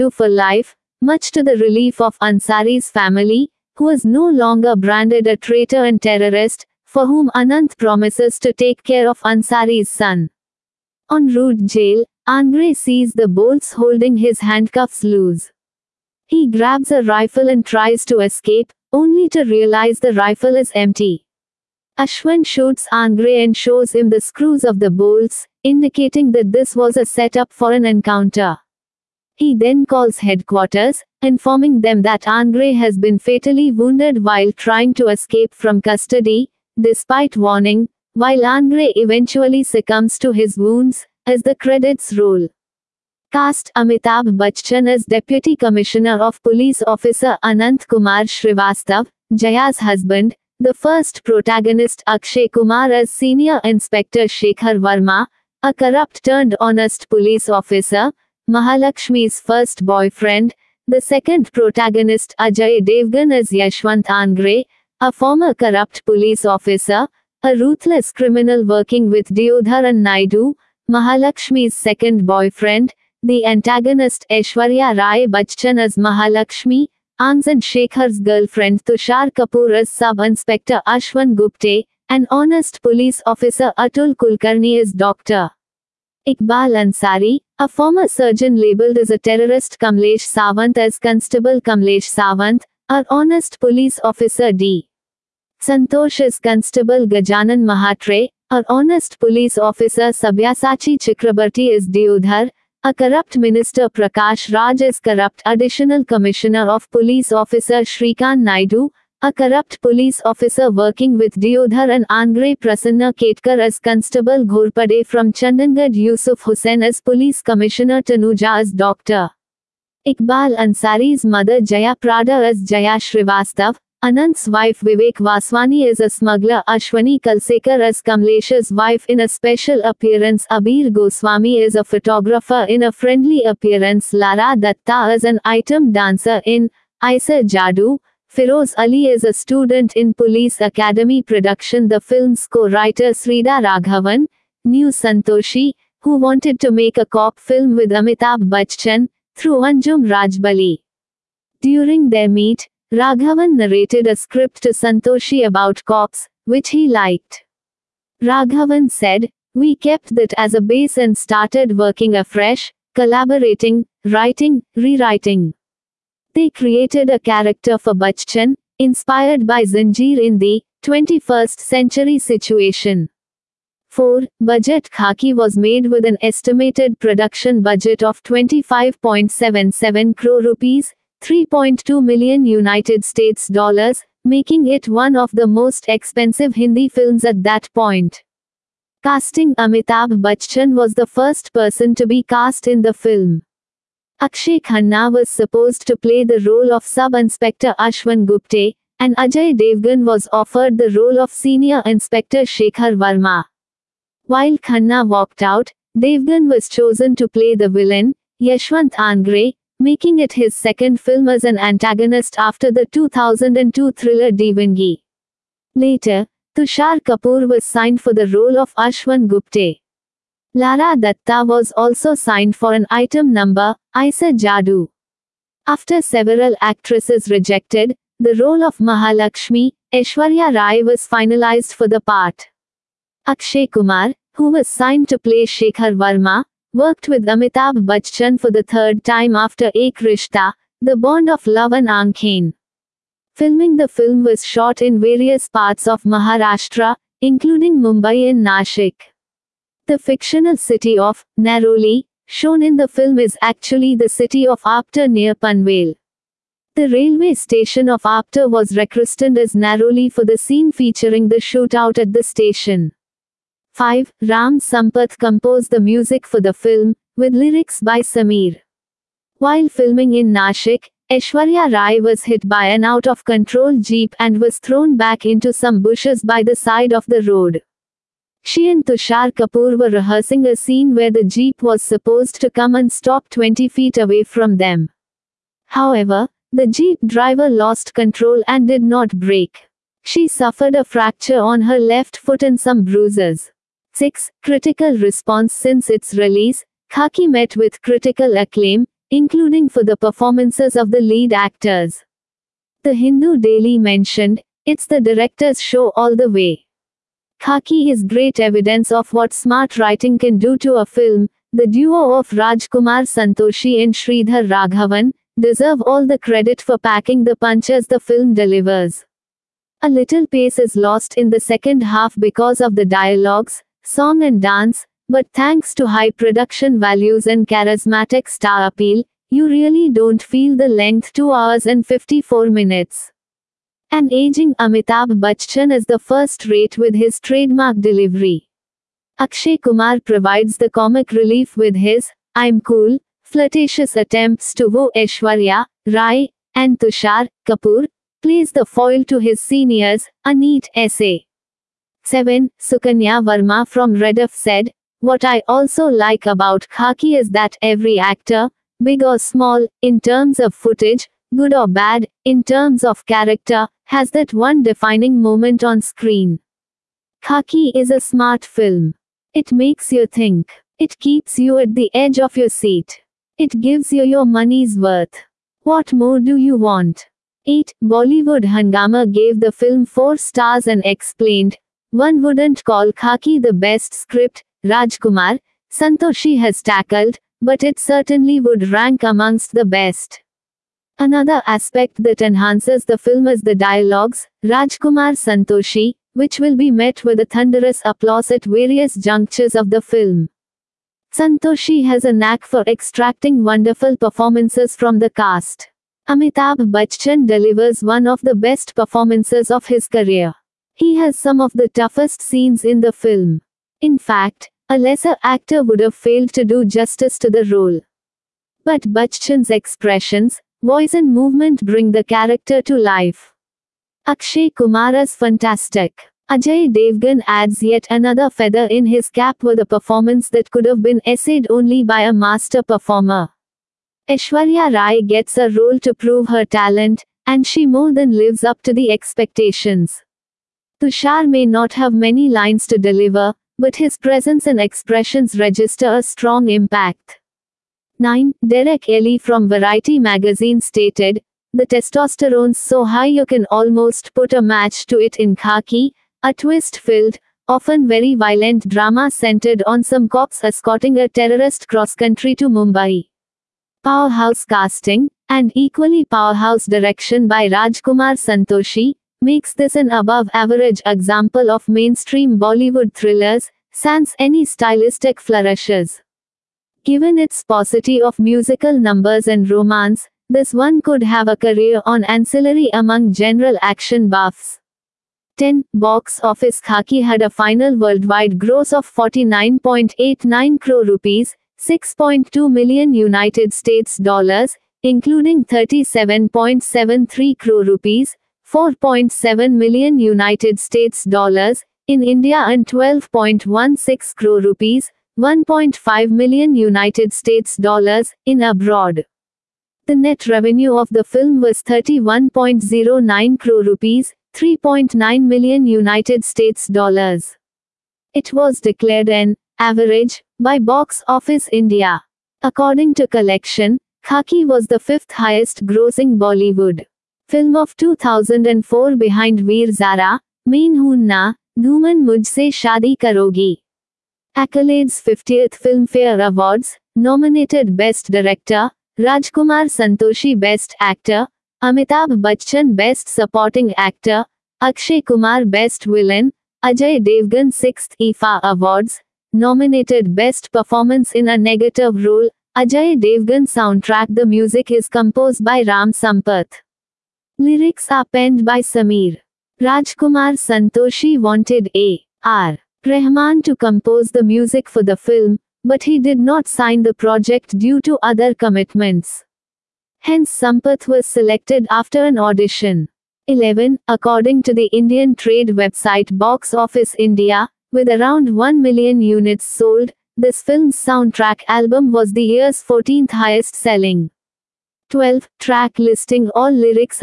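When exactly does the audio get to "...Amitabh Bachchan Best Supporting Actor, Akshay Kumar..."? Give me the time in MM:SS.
09:01.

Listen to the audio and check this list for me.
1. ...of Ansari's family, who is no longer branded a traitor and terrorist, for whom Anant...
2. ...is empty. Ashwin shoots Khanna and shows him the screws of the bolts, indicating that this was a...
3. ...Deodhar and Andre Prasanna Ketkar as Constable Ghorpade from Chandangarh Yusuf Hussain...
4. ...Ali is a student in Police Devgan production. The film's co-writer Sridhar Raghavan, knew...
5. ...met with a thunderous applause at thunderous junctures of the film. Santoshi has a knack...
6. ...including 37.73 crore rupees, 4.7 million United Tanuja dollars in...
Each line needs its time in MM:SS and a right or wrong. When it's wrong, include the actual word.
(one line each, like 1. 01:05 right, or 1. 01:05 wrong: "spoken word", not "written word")
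1. 00:01 right
2. 00:20 wrong: "Angre", not "Khanna"
3. 01:51 right
4. 02:18 wrong: "Academy", not "Devgan"
5. 06:36 wrong: "various", not "thunderous"
6. 08:14 wrong: "States", not "Tanuja".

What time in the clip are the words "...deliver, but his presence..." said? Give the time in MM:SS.
07:22.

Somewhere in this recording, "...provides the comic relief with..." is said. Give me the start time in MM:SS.
05:40.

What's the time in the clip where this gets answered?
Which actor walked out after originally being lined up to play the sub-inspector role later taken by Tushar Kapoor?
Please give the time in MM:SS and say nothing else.
03:14.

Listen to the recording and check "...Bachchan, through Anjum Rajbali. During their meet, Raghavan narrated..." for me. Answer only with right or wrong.
right.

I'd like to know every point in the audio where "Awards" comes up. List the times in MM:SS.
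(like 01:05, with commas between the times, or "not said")
08:56, 09:08.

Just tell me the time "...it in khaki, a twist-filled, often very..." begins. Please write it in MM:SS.
07:34.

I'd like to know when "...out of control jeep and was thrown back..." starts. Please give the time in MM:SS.
04:32.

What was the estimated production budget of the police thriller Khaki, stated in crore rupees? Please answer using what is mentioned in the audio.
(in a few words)
25.77 crore rupees.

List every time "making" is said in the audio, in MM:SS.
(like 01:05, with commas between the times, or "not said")
03:04, 03:29.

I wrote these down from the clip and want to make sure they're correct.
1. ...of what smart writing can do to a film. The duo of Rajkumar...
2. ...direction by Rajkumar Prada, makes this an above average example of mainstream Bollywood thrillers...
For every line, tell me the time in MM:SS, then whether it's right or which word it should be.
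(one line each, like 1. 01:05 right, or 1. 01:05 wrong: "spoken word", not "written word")
1. 05:08 right
2. 07:46 wrong: "Santoshi", not "Prada".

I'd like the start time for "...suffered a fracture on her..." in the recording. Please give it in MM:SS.
04:50.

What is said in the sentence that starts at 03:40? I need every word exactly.
Lara Datta was also signed for an item number, Isa Jadu.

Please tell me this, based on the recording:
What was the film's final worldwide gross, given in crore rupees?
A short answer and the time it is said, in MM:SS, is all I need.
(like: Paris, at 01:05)
49.89 crore rupees, at 08:08.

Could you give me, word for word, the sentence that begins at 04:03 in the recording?
Filming the film was shot in various parts of Maharashtra, including Mumbai and Nashik.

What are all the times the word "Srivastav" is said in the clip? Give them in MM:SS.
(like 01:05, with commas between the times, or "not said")
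00:48, 02:02.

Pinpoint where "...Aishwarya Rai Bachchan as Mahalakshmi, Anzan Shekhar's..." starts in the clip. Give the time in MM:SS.
01:14.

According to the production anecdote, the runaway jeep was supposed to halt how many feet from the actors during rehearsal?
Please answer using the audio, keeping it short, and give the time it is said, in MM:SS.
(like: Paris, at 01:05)
20 feet, at 04:43.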